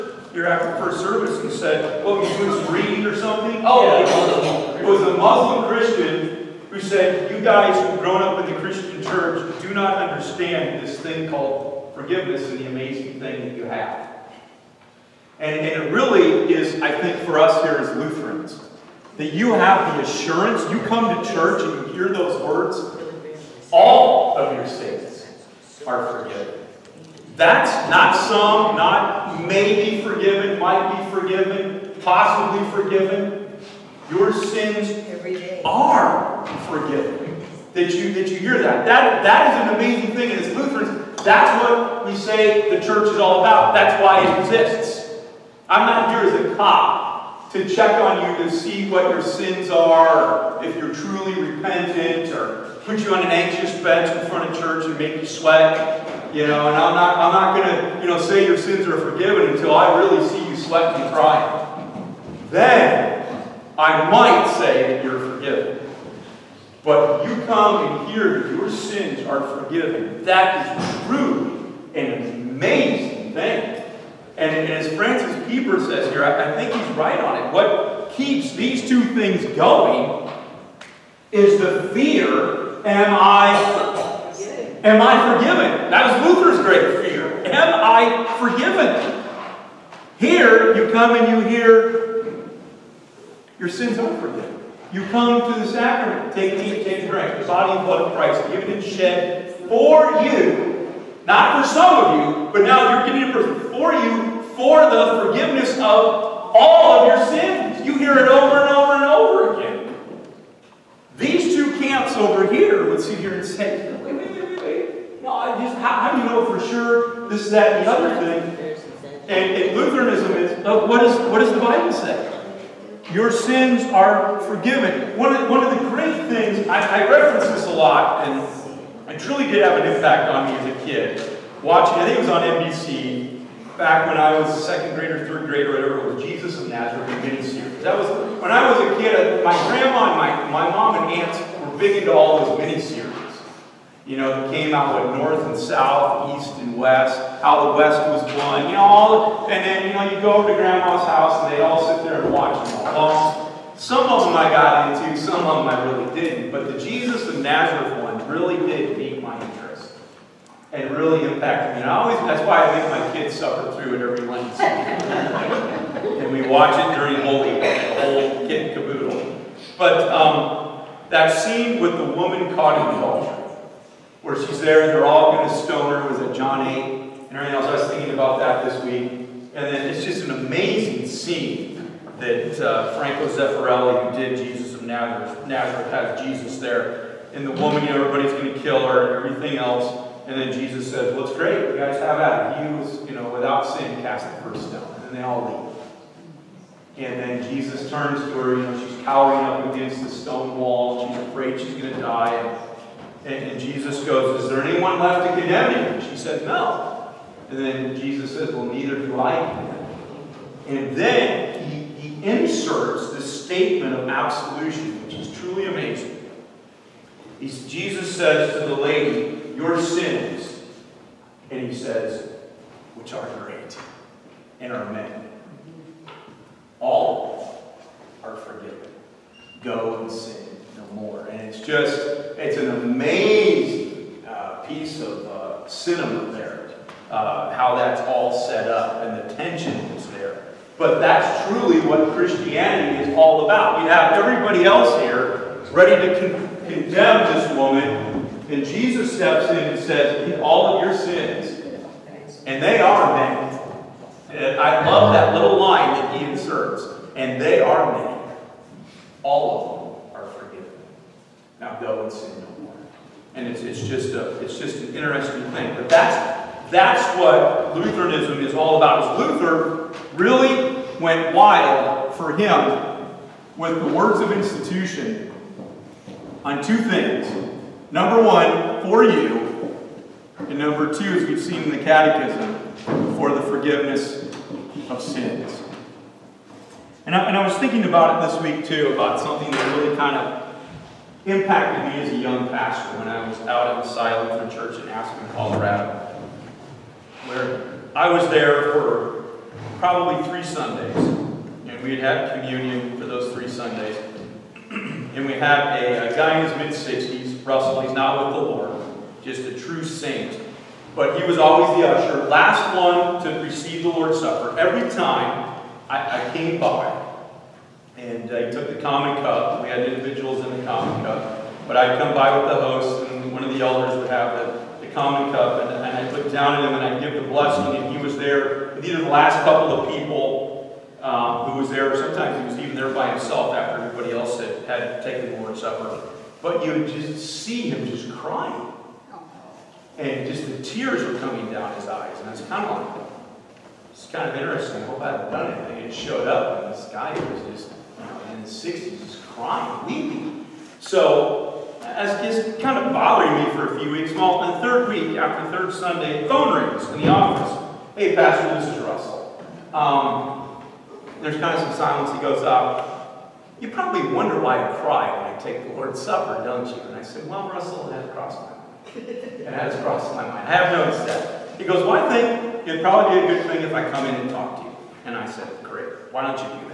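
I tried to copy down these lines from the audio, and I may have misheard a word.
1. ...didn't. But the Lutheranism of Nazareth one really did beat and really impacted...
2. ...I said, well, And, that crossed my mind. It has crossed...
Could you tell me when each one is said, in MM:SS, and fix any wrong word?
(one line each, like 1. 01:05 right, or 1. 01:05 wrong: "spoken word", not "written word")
1. 02:36 wrong: "Jesus", not "Lutheranism"
2. 06:06 wrong: "Russell", not "And".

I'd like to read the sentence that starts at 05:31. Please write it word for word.
Sometimes he was even there by himself after everybody else had, had taken the Lord's Supper.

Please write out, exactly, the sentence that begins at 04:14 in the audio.
And I love that little line that he inserts, and they are many.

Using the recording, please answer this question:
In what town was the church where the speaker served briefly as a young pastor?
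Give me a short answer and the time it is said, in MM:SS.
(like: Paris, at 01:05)
Aspen, Colorado, at 04:54.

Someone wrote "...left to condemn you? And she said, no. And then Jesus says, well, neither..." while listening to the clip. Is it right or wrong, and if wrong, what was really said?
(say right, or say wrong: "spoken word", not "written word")
right.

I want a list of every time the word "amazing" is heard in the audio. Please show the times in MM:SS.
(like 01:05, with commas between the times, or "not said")
00:12, 00:39, 01:12, 03:00, 03:35, 03:52.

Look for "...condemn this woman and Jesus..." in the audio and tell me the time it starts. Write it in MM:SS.
04:06.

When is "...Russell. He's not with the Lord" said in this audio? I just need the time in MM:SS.
05:07.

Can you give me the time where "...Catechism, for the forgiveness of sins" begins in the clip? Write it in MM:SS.
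04:41.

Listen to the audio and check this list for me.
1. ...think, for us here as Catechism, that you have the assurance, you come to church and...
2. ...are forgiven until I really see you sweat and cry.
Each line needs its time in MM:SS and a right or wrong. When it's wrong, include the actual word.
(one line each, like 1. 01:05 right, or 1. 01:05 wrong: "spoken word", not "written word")
1. 00:16 wrong: "Lutherans", not "Catechism"
2. 00:58 right.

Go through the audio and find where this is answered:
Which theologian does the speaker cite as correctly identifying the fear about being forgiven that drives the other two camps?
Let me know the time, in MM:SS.
01:14.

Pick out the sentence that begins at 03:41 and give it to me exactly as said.
And he says, which are great and are many.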